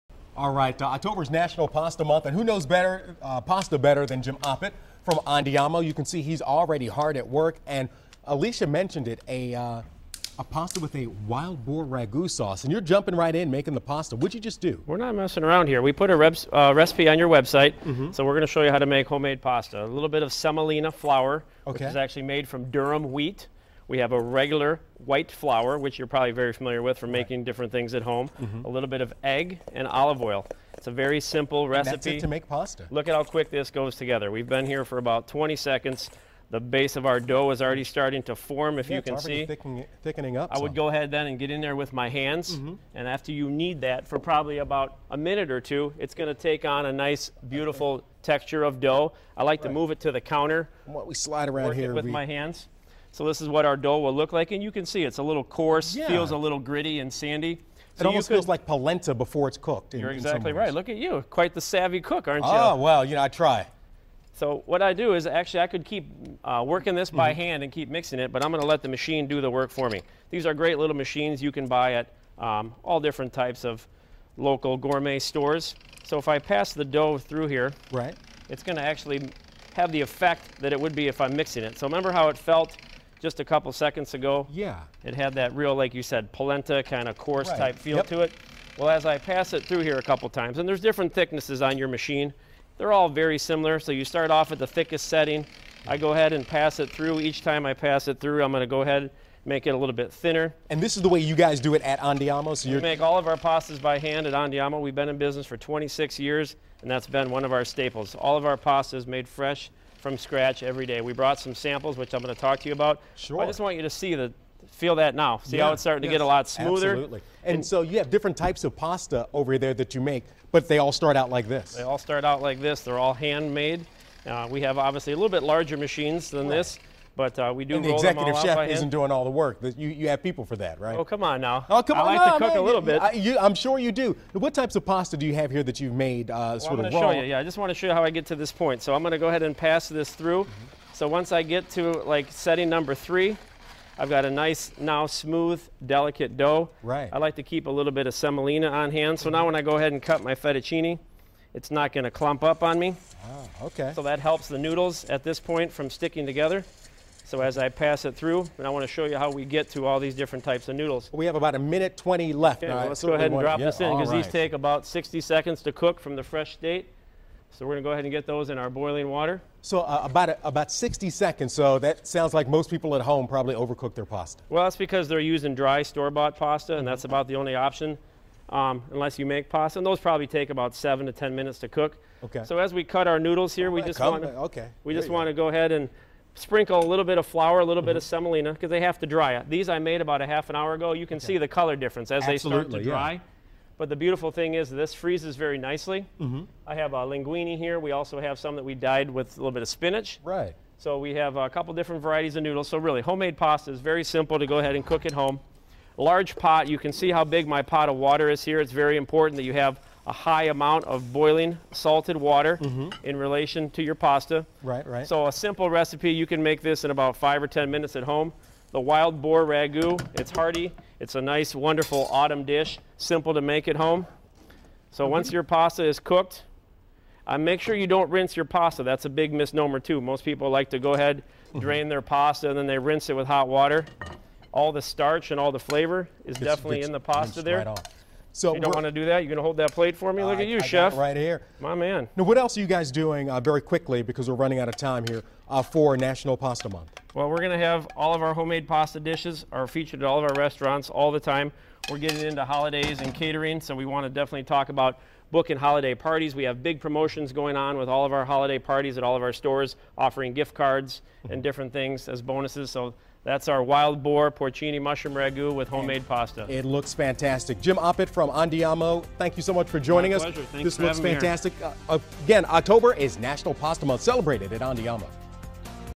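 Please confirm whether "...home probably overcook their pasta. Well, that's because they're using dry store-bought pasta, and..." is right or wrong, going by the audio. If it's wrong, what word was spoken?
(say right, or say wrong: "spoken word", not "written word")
right.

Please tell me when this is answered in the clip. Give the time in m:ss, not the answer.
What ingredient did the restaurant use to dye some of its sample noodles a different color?
3:19.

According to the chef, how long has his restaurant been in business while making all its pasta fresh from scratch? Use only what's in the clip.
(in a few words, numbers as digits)
26 years.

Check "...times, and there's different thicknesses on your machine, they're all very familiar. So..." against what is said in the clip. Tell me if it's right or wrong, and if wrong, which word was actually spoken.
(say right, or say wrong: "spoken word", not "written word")
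wrong: "similar", not "familiar".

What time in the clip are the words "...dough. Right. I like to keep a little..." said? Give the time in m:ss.
2:26.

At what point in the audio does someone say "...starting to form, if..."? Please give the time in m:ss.
0:37.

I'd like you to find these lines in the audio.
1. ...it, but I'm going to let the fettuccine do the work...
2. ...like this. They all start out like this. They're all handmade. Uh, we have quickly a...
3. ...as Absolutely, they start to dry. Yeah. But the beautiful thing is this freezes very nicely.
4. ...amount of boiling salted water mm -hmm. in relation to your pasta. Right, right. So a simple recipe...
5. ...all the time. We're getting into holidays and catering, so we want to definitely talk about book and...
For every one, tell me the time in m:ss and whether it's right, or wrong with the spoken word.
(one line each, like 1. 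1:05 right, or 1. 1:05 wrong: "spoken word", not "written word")
1. 1:08 wrong: "machine", not "fettuccine"
2. 2:01 wrong: "obviously", not "quickly"
3. 3:12 right
4. 3:30 right
5. 4:10 right.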